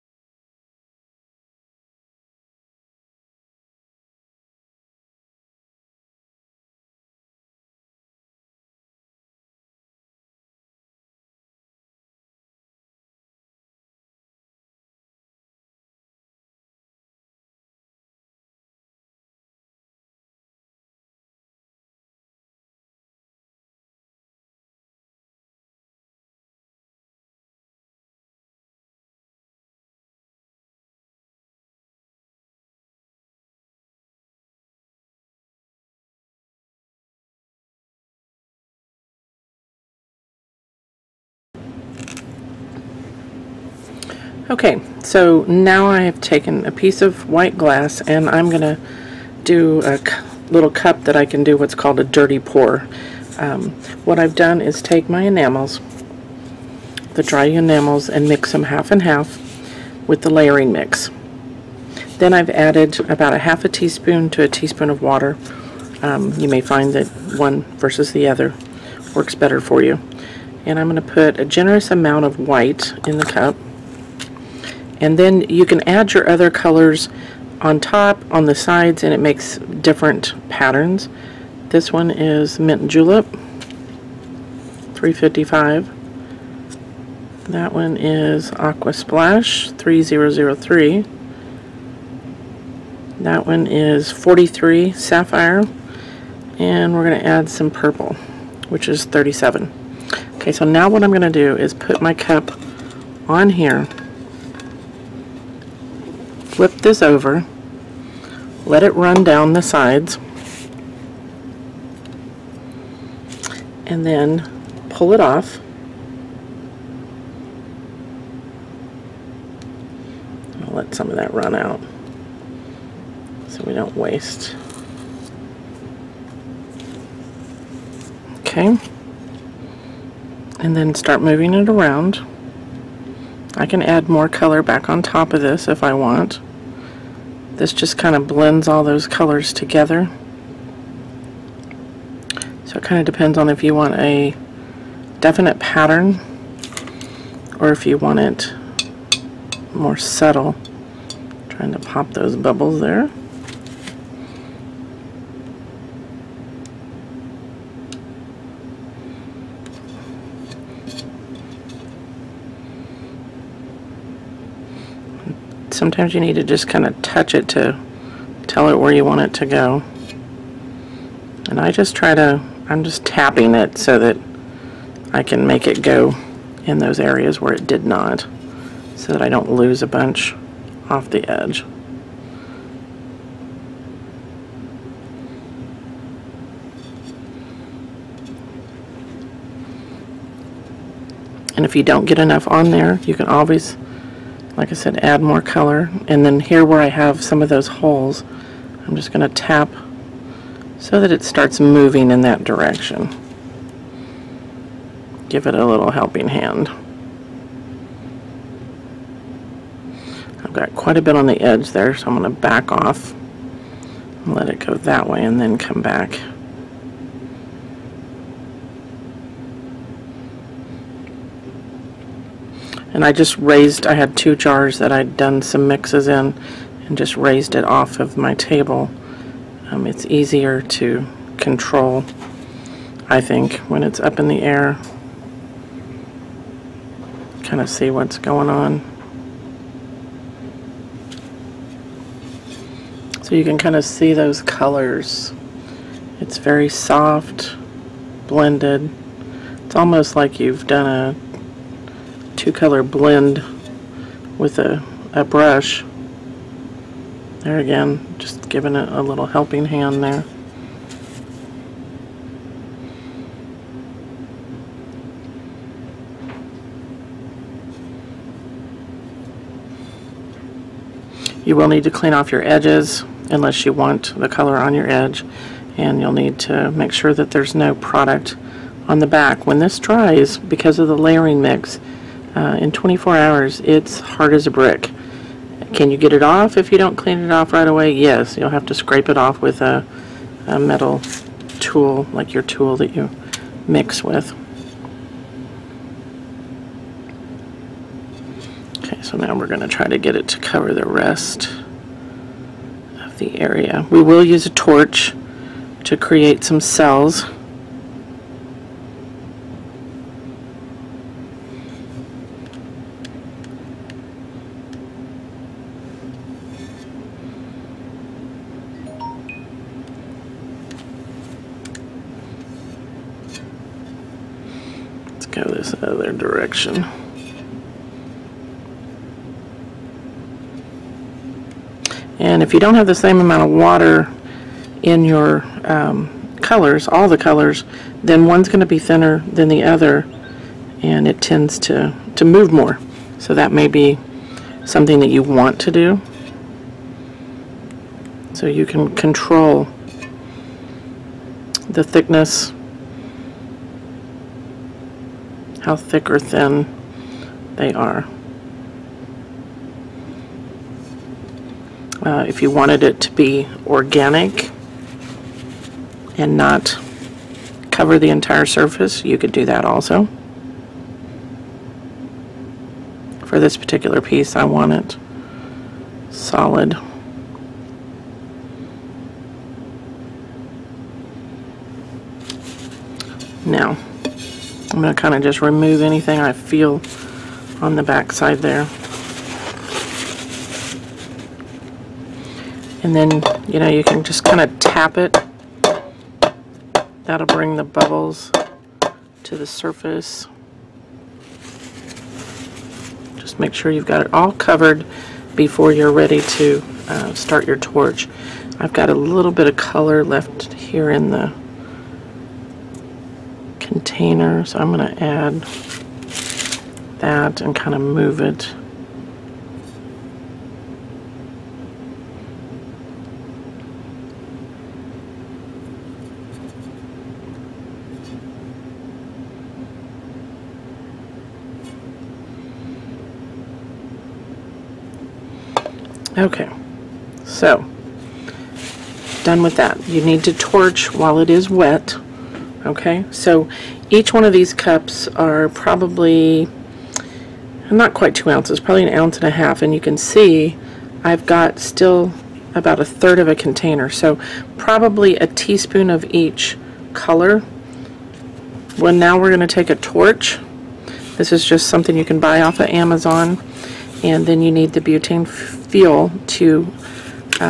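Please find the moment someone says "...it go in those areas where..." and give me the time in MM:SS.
02:55.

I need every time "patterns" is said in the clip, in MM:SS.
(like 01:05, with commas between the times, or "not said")
01:20, 02:25.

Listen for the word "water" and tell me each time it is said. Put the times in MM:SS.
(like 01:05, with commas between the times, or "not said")
01:04, 05:33.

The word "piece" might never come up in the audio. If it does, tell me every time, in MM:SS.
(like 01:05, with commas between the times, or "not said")
00:46, 06:13.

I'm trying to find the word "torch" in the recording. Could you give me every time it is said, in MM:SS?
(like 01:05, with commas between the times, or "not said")
05:04, 06:47, 07:20, 07:39.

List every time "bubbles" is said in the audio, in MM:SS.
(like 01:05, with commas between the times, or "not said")
02:32, 06:37.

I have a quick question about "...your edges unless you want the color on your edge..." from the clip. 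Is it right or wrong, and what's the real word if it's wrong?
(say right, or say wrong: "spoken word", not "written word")
right.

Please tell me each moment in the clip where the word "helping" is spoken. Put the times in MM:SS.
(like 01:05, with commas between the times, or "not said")
03:25, 04:19.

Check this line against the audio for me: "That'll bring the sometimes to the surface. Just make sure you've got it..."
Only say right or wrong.
wrong.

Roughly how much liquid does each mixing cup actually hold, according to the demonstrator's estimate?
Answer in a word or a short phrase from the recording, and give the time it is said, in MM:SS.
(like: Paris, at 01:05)
1.5 ounces, at 07:28.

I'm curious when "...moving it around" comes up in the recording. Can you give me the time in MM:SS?
02:11.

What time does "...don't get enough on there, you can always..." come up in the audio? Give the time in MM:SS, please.
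03:11.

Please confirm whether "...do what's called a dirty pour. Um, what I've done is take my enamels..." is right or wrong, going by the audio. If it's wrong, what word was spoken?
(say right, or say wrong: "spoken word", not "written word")
right.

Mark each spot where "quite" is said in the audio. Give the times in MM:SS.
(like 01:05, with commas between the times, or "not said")
03:30, 07:27.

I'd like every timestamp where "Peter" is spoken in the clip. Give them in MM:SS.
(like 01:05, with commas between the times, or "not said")
not said.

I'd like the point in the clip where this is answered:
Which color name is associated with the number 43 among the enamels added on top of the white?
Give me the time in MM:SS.
01:34.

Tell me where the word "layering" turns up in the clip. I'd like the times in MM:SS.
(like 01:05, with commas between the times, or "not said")
01:00, 04:40.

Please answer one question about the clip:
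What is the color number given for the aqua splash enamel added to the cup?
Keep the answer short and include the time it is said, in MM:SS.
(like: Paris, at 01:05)
3003, at 01:29.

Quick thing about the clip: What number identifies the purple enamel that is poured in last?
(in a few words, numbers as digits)
37.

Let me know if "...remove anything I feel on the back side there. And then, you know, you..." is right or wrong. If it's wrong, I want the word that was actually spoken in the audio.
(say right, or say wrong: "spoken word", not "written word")
right.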